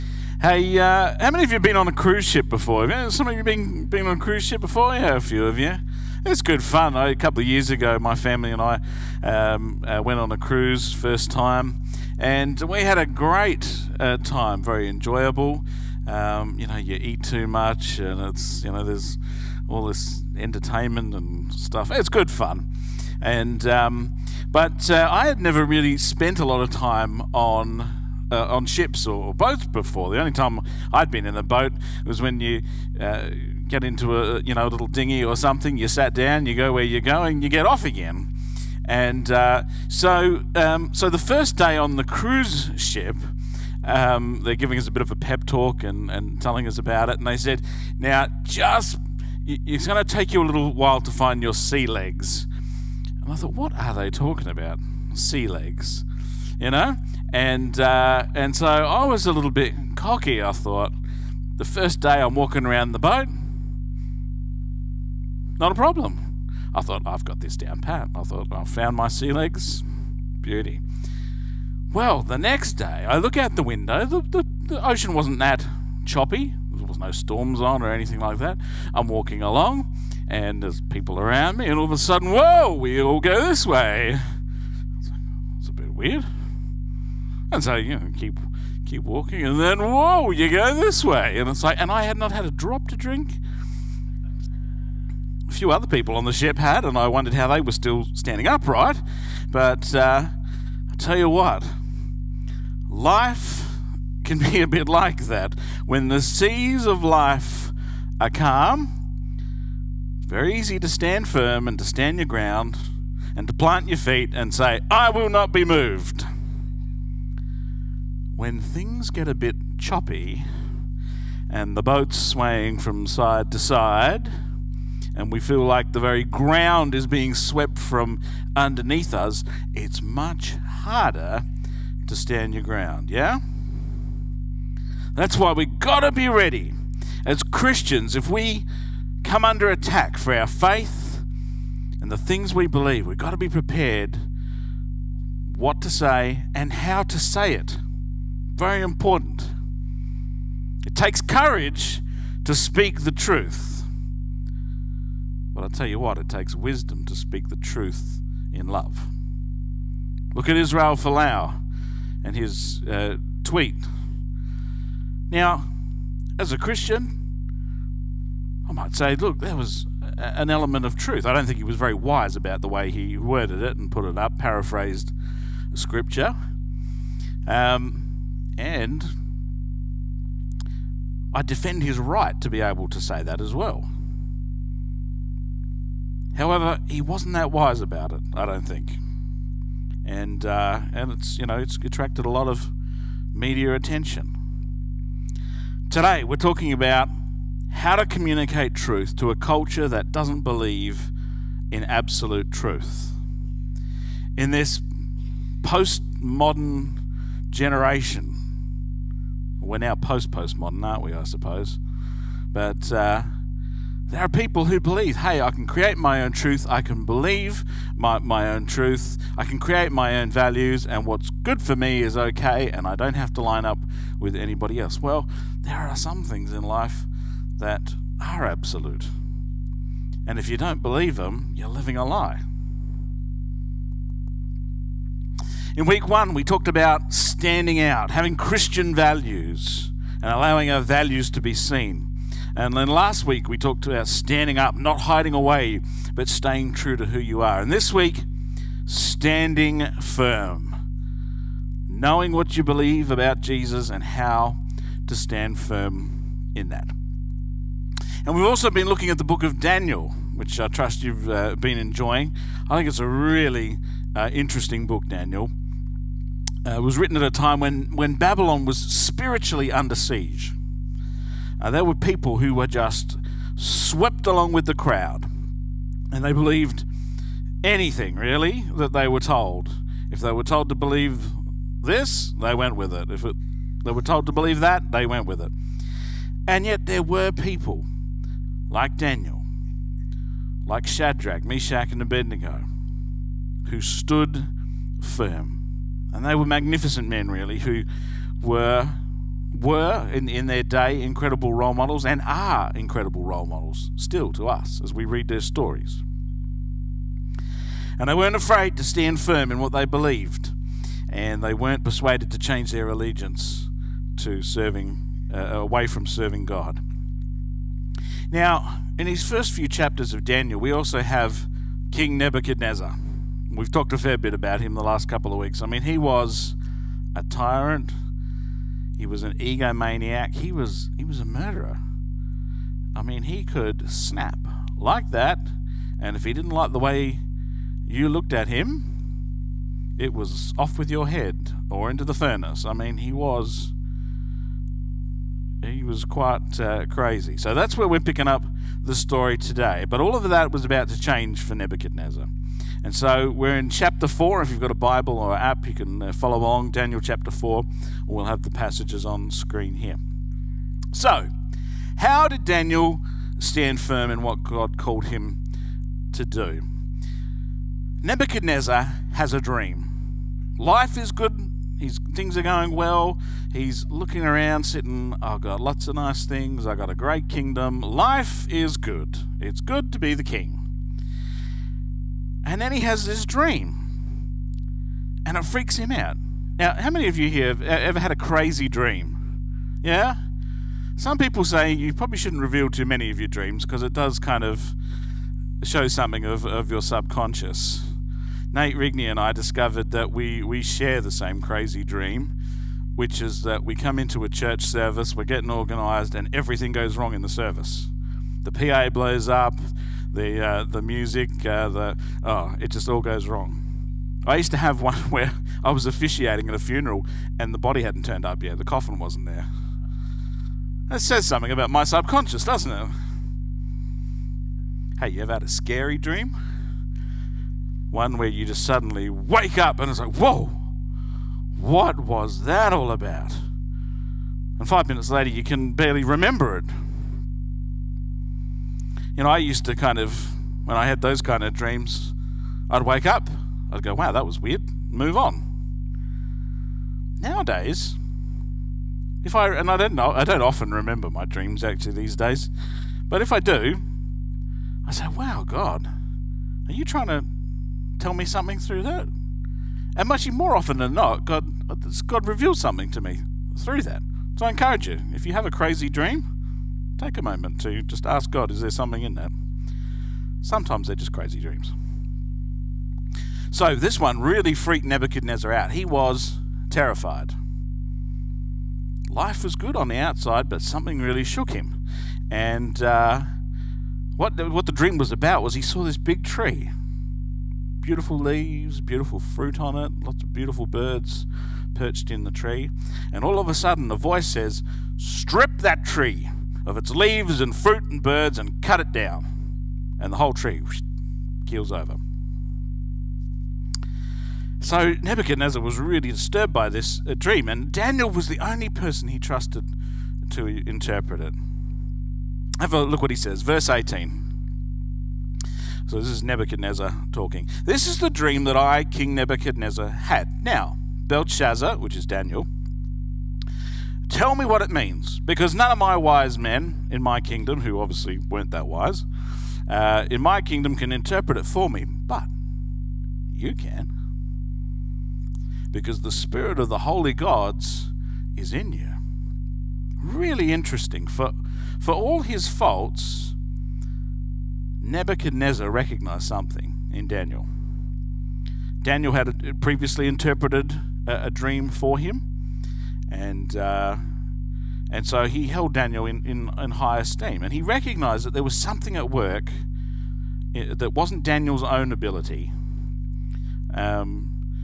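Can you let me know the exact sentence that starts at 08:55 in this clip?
Because the spirit of the holy gods is in you.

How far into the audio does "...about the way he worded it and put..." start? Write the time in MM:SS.
02:52.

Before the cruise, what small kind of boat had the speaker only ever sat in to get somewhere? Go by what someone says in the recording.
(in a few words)
dinghy.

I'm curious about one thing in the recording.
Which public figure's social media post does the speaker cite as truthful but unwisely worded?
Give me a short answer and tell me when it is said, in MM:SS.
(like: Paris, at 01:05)
Israel Folau, at 02:40.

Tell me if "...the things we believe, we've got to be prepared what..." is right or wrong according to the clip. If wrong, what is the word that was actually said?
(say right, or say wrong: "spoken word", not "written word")
right.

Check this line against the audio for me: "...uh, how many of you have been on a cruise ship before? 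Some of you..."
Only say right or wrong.
right.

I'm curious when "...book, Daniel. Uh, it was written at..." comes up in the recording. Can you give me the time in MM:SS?
04:24.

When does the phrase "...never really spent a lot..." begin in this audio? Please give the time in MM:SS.
00:25.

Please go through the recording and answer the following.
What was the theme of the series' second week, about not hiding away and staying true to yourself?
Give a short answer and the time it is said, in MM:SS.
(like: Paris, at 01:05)
standing up, at 04:04.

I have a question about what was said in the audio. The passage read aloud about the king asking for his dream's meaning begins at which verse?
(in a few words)
18.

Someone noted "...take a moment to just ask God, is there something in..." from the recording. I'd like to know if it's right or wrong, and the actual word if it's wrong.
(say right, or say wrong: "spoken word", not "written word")
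right.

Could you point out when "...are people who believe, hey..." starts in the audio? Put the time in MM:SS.
03:34.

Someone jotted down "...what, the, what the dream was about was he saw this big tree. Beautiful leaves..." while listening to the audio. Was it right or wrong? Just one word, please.
right.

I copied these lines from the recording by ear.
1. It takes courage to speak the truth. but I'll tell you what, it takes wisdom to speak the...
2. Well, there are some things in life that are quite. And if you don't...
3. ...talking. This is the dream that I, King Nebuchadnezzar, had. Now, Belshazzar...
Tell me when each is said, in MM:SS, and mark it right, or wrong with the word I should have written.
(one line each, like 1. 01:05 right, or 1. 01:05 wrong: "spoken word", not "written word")
1. 02:30 right
2. 03:45 wrong: "absolute", not "quite"
3. 08:37 right.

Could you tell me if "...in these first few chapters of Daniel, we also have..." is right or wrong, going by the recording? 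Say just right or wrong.
right.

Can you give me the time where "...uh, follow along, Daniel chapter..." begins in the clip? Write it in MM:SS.
05:56.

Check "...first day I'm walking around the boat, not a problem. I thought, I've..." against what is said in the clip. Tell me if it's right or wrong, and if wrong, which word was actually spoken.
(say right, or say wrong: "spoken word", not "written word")
right.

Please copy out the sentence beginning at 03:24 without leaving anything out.
In this postmodern generation, we're now post postmodern, aren't we?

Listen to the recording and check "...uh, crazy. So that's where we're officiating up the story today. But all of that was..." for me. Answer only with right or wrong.
wrong.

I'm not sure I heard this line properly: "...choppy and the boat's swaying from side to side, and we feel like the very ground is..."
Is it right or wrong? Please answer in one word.
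right.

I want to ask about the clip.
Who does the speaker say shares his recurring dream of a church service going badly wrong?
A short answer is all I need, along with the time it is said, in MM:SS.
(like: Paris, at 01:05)
Nate Rigney, at 06:38.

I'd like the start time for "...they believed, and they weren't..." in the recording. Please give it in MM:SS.
05:09.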